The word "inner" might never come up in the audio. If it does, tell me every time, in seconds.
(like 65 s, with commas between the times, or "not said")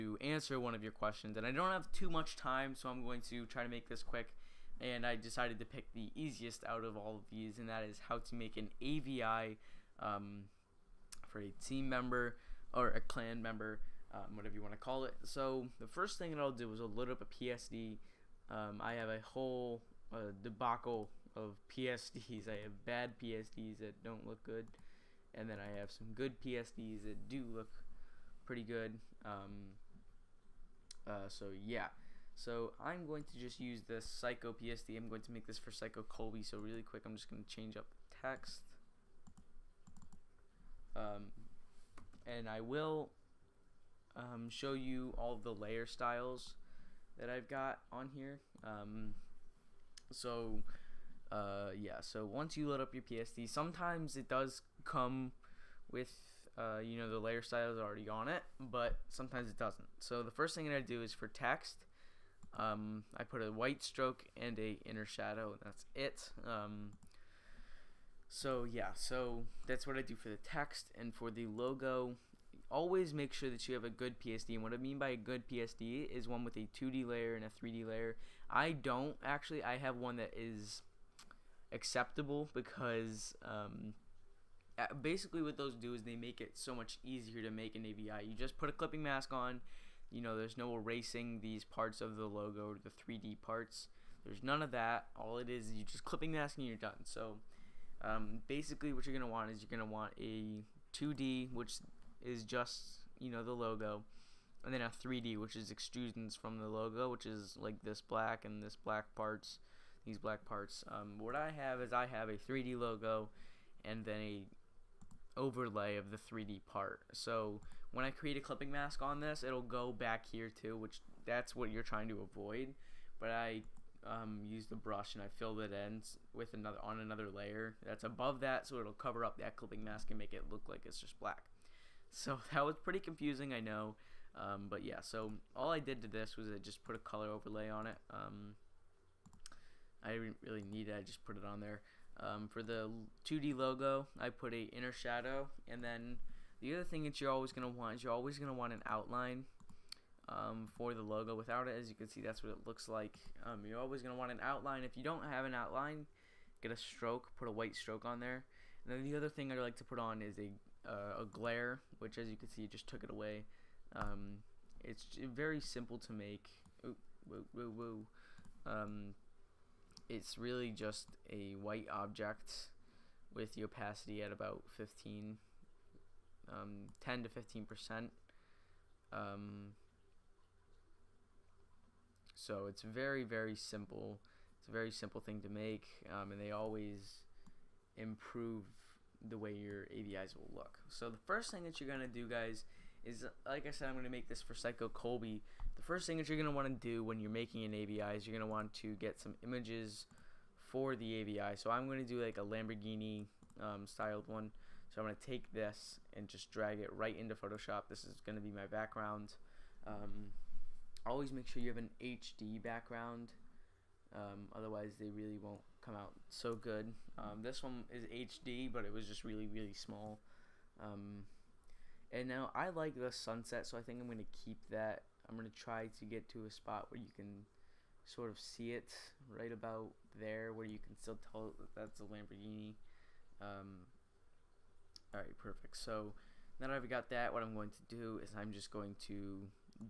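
64 s, 144 s.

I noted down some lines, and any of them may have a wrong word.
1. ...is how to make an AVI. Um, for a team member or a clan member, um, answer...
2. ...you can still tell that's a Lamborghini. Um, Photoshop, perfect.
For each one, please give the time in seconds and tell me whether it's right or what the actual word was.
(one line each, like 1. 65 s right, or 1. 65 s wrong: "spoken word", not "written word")
1. 7 s wrong: "whatever", not "answer"
2. 230 s wrong: "Alright", not "Photoshop".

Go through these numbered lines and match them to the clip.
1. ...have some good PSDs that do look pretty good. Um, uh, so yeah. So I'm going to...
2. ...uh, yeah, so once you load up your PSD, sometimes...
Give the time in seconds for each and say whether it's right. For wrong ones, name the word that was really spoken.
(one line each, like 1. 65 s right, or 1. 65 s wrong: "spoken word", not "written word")
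1. 25 s right
2. 51 s right.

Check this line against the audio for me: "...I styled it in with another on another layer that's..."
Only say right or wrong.
wrong.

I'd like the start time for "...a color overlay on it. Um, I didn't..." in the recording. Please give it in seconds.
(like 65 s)
136 s.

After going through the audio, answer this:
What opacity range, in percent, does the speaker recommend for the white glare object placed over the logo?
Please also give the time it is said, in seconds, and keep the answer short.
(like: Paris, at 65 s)
10 to 15, at 176 s.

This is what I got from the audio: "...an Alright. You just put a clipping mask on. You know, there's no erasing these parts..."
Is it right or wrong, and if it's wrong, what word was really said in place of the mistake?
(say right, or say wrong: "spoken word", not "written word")
wrong: "AVI", not "Alright".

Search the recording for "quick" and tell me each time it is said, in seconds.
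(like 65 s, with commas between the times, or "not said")
4 s, 36 s.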